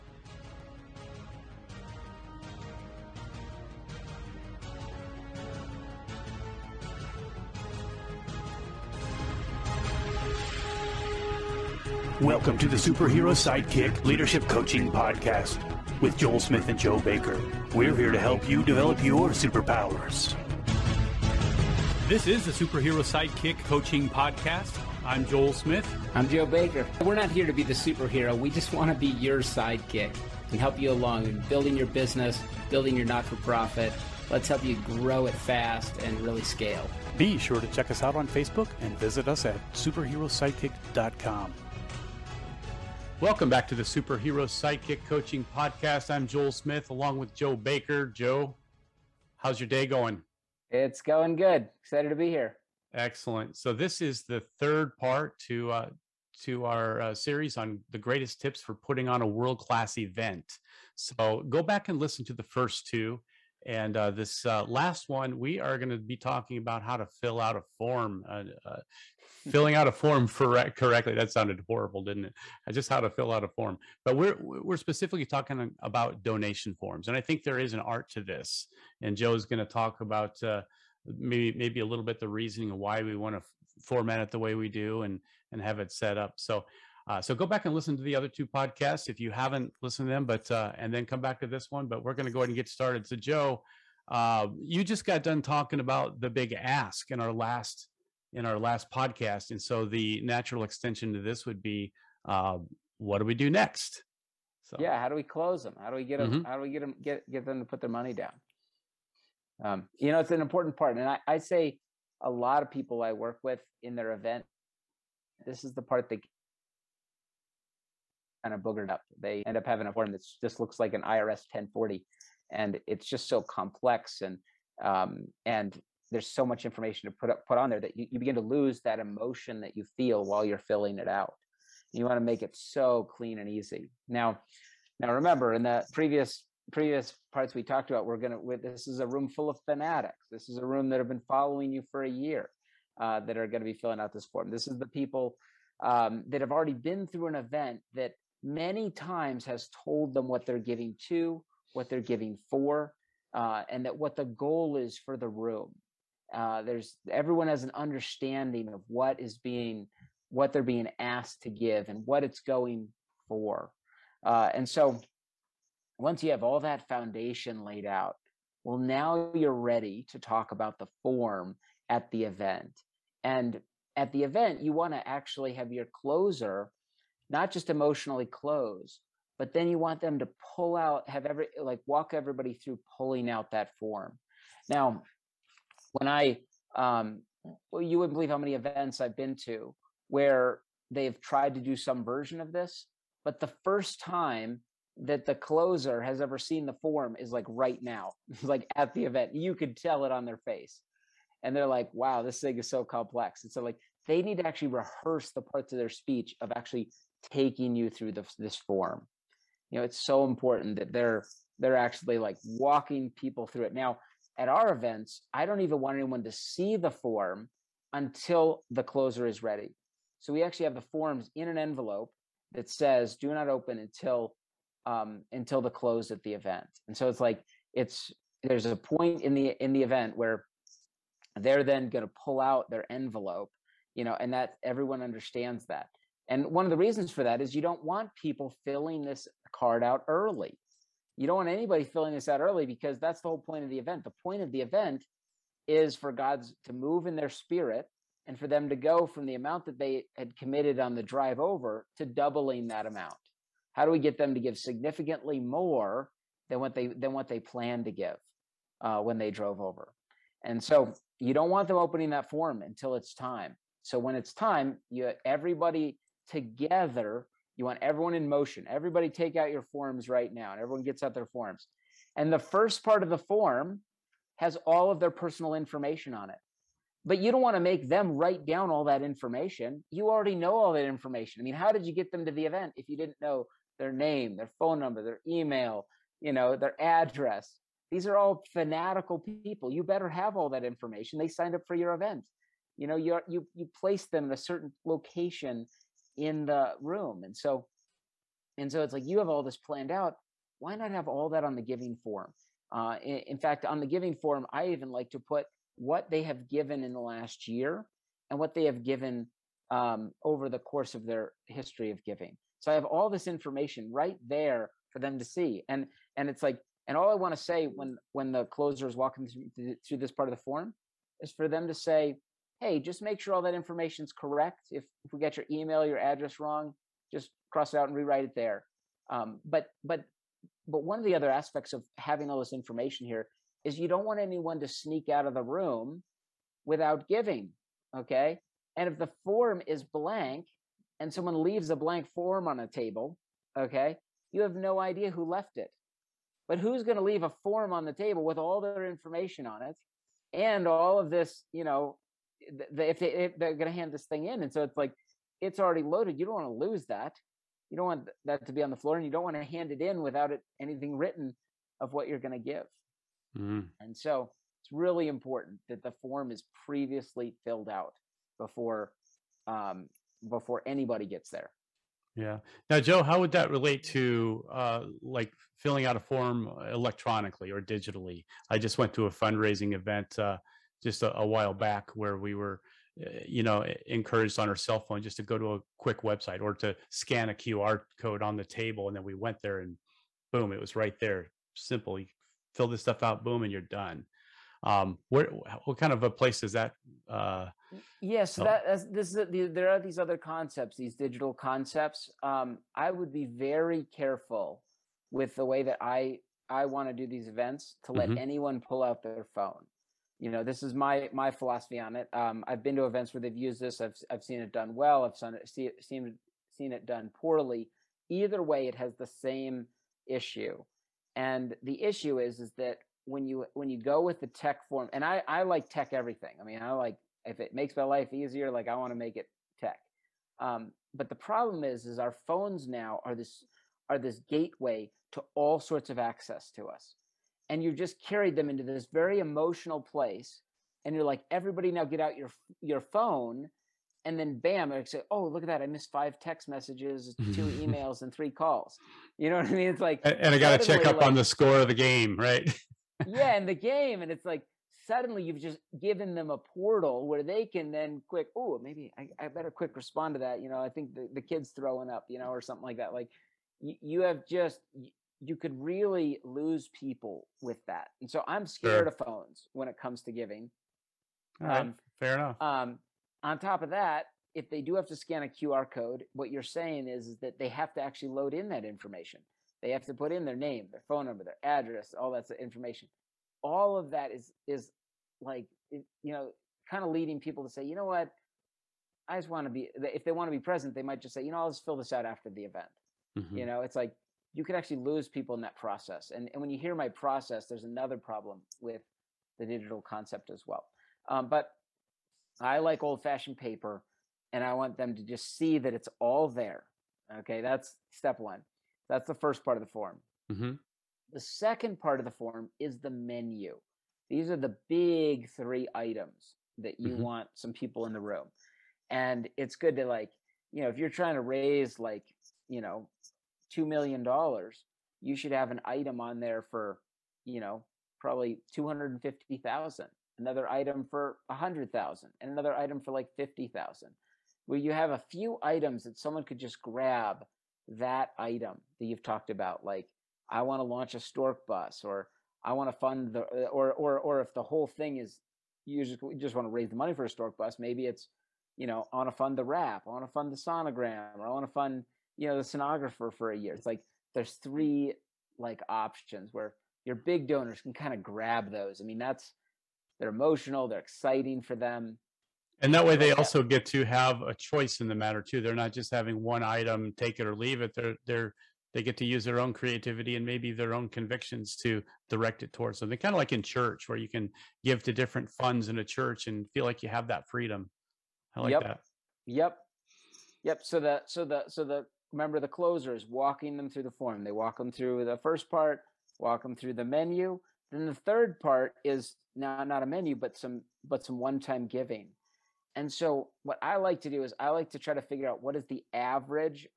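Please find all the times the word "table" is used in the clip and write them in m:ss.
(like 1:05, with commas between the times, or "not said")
5:42, 5:47, 6:28.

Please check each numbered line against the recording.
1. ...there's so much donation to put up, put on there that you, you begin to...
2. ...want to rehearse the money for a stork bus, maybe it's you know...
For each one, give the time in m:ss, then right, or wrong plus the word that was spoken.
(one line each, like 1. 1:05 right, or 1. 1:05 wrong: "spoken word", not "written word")
1. 2:06 wrong: "information", not "donation"
2. 9:06 wrong: "raise", not "rehearse".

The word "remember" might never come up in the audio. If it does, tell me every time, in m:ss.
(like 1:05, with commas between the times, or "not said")
2:15, 9:42.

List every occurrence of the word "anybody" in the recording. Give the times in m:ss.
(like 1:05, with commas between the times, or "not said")
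4:01, 6:10.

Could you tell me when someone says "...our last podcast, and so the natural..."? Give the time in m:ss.
1:38.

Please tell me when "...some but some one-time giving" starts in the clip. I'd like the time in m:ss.
9:50.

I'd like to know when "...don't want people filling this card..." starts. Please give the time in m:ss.
3:57.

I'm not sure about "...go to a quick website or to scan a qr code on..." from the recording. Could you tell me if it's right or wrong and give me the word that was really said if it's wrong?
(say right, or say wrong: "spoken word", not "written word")
right.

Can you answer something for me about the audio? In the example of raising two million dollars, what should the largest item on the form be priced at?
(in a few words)
$250,000.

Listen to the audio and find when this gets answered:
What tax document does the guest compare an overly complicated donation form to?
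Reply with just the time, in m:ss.
2:01.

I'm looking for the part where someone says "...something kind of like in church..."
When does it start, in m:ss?
9:32.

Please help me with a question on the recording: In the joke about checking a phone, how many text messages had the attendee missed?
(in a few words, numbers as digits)
5.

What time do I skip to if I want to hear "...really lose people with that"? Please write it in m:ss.
7:45.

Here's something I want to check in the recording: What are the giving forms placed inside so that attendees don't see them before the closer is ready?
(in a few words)
an envelope.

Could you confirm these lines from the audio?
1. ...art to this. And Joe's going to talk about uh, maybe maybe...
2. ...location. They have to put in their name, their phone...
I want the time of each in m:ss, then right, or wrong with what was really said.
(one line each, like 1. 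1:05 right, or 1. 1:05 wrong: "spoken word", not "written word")
1. 1:17 right
2. 7:58 wrong: "information", not "location".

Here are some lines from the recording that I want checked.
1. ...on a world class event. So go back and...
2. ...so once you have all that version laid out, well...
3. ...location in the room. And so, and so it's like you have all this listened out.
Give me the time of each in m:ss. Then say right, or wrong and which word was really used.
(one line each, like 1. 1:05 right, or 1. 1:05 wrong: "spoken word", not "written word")
1. 0:59 right
2. 2:44 wrong: "foundation", not "version"
3. 4:54 wrong: "planned", not "listened".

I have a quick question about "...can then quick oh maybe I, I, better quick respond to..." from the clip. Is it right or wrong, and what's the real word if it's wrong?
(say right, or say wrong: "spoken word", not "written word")
right.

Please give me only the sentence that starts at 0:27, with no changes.
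We're not here to be the superhero.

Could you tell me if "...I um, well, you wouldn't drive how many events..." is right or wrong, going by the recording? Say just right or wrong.
wrong.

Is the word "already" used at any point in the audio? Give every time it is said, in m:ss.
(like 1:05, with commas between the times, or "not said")
2:26, 4:40, 5:55.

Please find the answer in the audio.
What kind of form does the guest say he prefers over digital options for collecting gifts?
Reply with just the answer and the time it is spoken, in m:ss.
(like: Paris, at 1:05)
old fashioned paper, at 8:22.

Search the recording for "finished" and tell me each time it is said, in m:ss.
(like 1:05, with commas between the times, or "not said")
not said.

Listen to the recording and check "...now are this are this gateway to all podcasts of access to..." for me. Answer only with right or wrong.
wrong.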